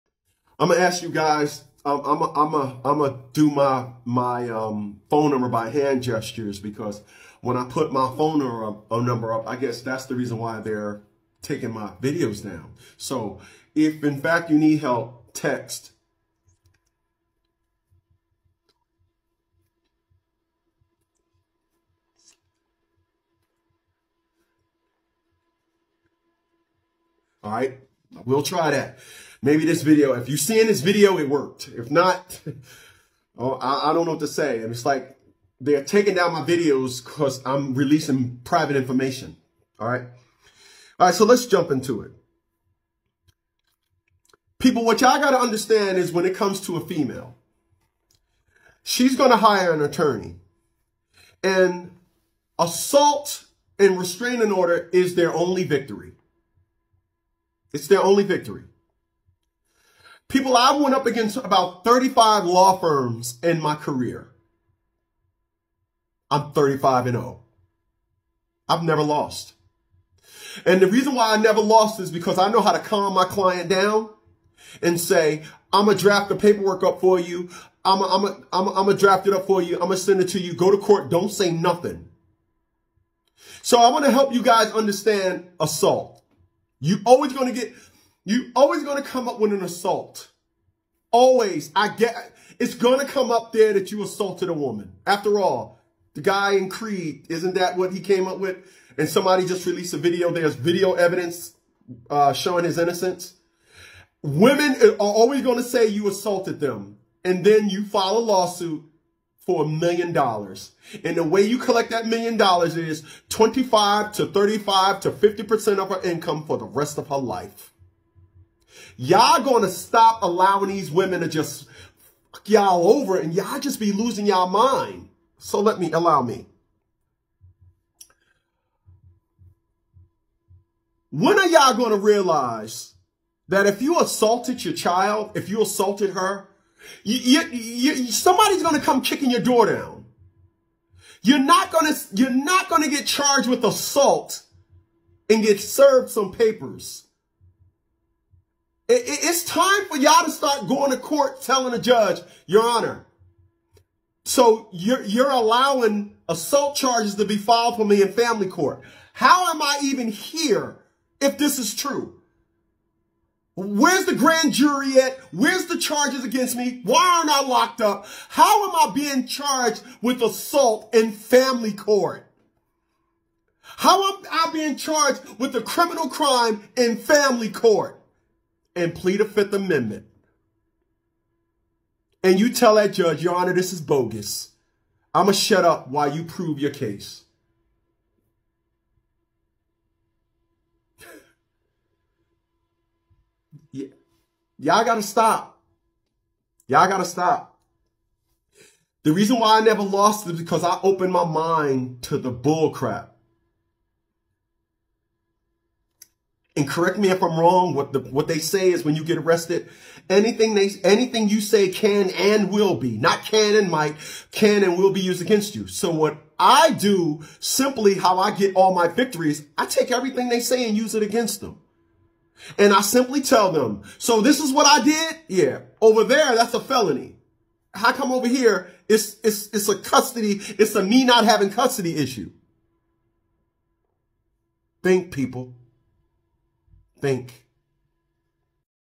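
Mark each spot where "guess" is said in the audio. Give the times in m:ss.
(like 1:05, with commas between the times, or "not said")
0:09.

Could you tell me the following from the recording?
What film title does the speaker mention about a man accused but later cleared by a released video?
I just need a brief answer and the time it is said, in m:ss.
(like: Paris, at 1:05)
Creed, at 1:36.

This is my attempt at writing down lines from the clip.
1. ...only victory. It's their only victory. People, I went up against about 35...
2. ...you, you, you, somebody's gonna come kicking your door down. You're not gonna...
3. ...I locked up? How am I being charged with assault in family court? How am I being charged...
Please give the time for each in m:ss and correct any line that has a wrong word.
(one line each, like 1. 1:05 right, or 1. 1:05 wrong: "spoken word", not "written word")
1. 0:55 right
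2. 2:17 right
3. 2:47 right.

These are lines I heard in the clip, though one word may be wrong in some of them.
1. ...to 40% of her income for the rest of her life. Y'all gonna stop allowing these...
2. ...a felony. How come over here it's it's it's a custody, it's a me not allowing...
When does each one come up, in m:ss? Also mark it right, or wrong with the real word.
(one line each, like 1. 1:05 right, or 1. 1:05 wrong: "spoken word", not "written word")
1. 1:55 wrong: "50", not "40"
2. 3:46 wrong: "having", not "allowing".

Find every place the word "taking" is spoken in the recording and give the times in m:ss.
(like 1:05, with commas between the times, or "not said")
0:11, 0:35.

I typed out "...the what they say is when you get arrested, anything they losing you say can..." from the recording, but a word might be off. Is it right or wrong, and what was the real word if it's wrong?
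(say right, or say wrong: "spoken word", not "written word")
wrong: "anything", not "losing".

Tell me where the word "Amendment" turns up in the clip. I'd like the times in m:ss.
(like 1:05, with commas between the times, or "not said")
2:59.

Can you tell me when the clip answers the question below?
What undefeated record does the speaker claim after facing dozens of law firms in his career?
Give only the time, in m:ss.
1:06.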